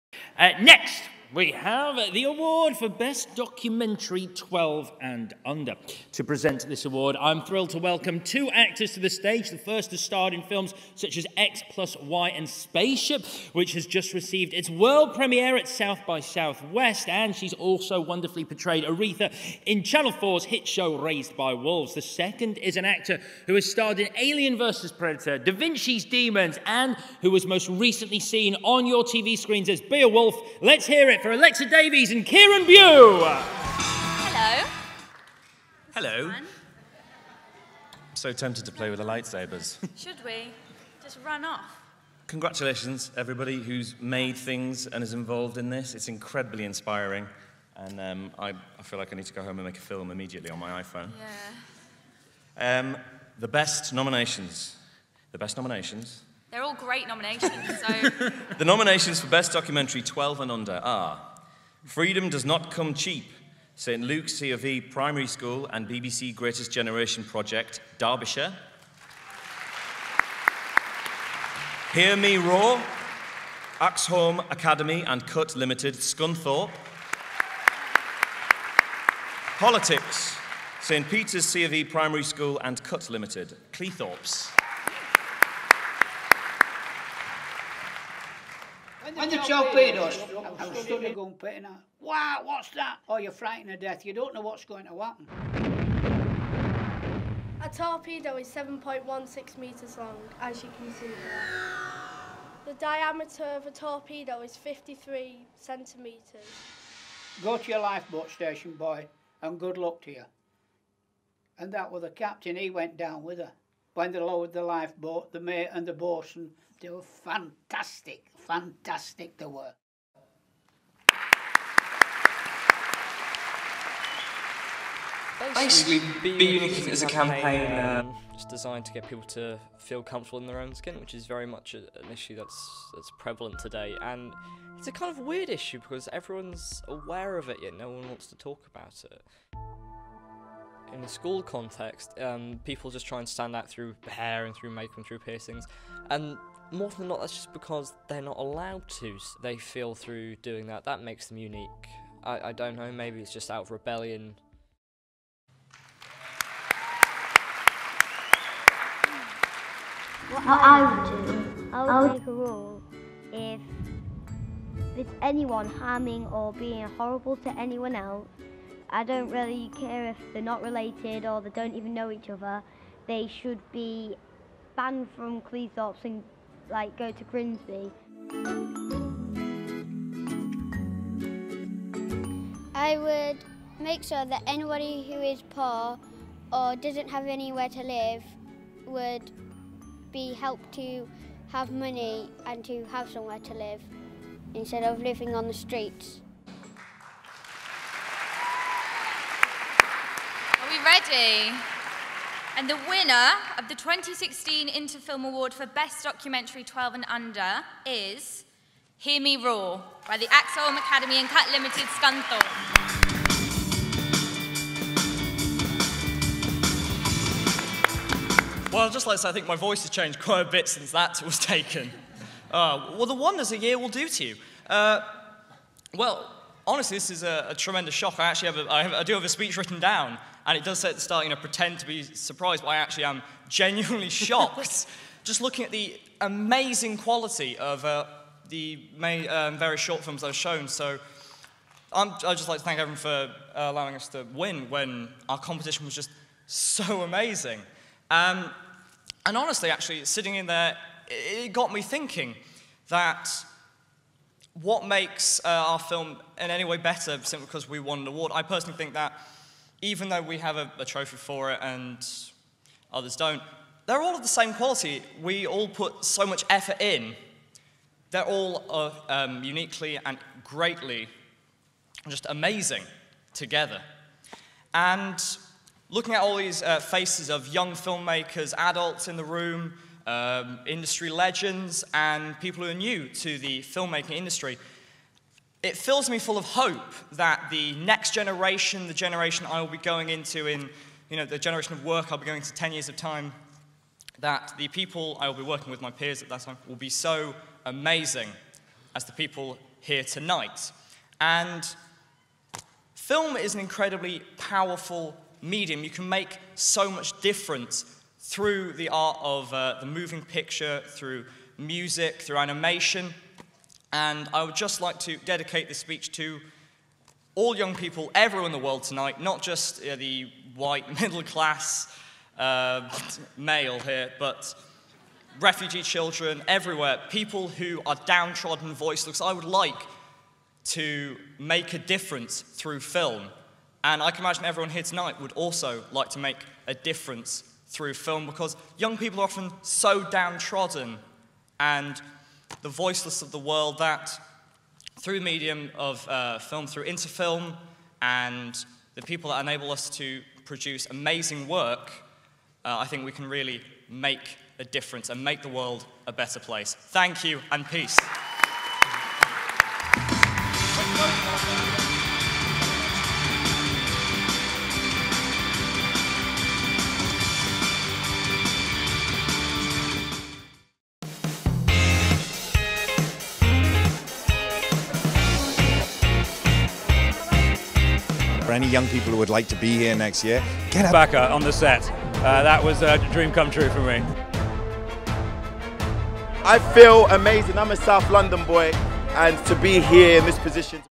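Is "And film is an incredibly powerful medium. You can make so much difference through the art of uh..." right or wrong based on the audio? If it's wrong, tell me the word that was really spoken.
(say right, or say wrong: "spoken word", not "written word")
right.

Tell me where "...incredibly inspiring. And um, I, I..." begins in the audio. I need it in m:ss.
0:46.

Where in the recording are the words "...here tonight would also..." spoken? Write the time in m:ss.
5:34.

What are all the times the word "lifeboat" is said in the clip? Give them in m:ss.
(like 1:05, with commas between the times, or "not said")
1:47, 1:54.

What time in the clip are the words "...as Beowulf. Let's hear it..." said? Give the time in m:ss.
0:29.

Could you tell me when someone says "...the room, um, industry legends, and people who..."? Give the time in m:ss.
4:39.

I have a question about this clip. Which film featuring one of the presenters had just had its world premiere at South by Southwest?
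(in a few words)
Spaceship.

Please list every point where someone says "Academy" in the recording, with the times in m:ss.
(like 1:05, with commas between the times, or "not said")
1:14, 3:30.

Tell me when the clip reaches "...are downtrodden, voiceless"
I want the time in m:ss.
5:27.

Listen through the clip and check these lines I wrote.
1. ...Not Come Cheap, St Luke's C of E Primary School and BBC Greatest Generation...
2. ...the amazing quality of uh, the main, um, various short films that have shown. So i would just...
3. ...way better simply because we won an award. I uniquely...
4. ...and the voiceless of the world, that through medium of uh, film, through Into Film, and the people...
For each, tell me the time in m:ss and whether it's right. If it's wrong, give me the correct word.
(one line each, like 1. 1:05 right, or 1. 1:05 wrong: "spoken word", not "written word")
1. 1:02 right
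2. 3:55 right
3. 4:16 wrong: "personally", not "uniquely"
4. 5:41 right.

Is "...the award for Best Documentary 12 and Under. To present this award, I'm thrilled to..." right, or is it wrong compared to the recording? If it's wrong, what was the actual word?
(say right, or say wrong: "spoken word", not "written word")
right.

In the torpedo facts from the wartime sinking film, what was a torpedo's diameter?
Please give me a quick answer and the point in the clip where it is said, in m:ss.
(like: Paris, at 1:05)
53 centimetres, at 1:44.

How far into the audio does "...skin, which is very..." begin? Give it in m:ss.
2:10.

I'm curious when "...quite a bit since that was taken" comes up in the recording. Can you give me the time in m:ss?
3:40.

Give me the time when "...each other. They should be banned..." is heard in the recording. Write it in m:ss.
2:52.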